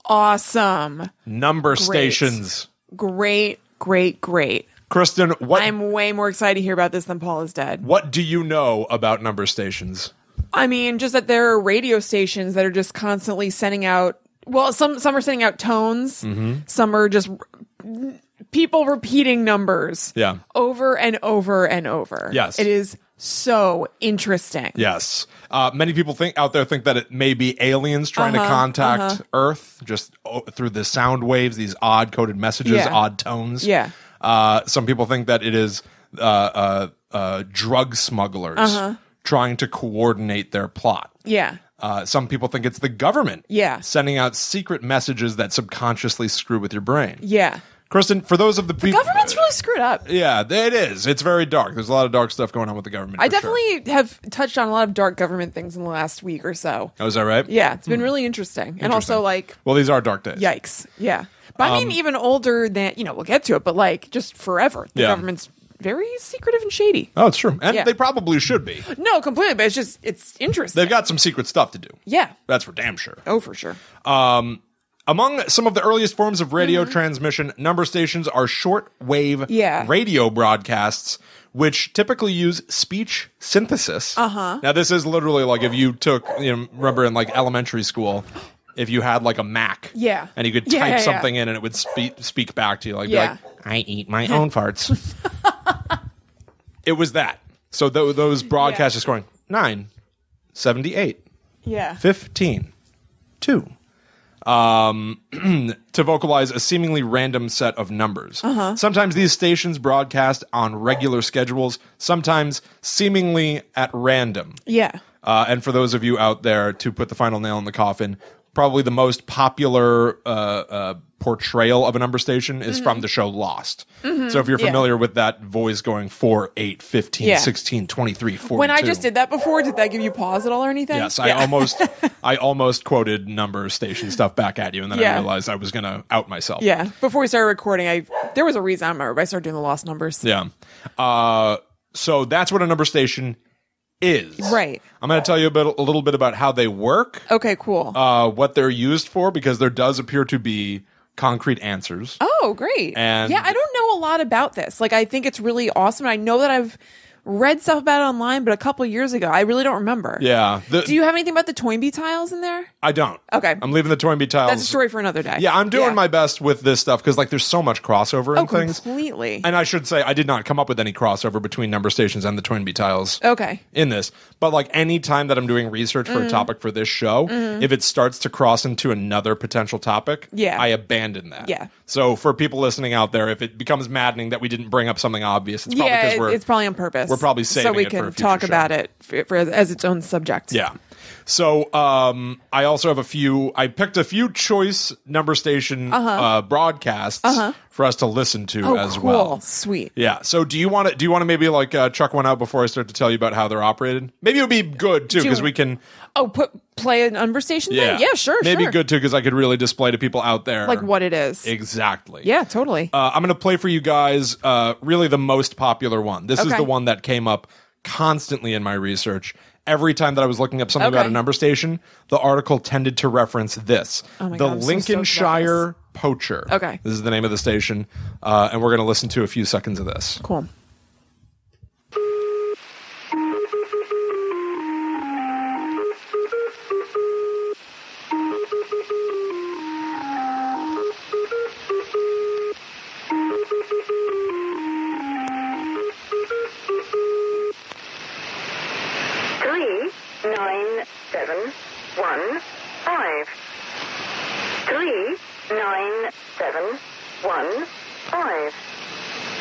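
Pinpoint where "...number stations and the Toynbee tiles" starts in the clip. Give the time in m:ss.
2:51.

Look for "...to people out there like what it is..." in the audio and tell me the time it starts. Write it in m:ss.
3:29.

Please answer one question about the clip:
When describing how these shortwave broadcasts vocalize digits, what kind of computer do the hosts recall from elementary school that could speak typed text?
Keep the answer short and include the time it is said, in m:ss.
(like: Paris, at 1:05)
Mac, at 1:29.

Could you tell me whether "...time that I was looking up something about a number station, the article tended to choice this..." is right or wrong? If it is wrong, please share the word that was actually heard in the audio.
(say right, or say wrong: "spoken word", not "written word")
wrong: "reference", not "choice".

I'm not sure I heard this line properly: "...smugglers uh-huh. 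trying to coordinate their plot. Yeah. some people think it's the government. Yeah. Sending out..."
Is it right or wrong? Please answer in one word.
right.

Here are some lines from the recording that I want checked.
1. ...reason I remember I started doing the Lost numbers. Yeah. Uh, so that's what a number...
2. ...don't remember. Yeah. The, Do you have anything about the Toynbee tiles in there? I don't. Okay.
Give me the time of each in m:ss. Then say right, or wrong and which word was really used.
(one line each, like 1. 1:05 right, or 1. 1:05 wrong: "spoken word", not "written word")
1. 2:18 right
2. 2:39 right.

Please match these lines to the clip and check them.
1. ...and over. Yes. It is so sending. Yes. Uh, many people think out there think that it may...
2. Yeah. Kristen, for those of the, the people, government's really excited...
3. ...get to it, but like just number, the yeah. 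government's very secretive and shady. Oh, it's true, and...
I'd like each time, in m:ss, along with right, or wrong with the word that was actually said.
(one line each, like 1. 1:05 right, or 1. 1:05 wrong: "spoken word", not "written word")
1. 0:21 wrong: "interesting", not "sending"
2. 0:47 wrong: "screwed", not "excited"
3. 1:03 wrong: "forever", not "number".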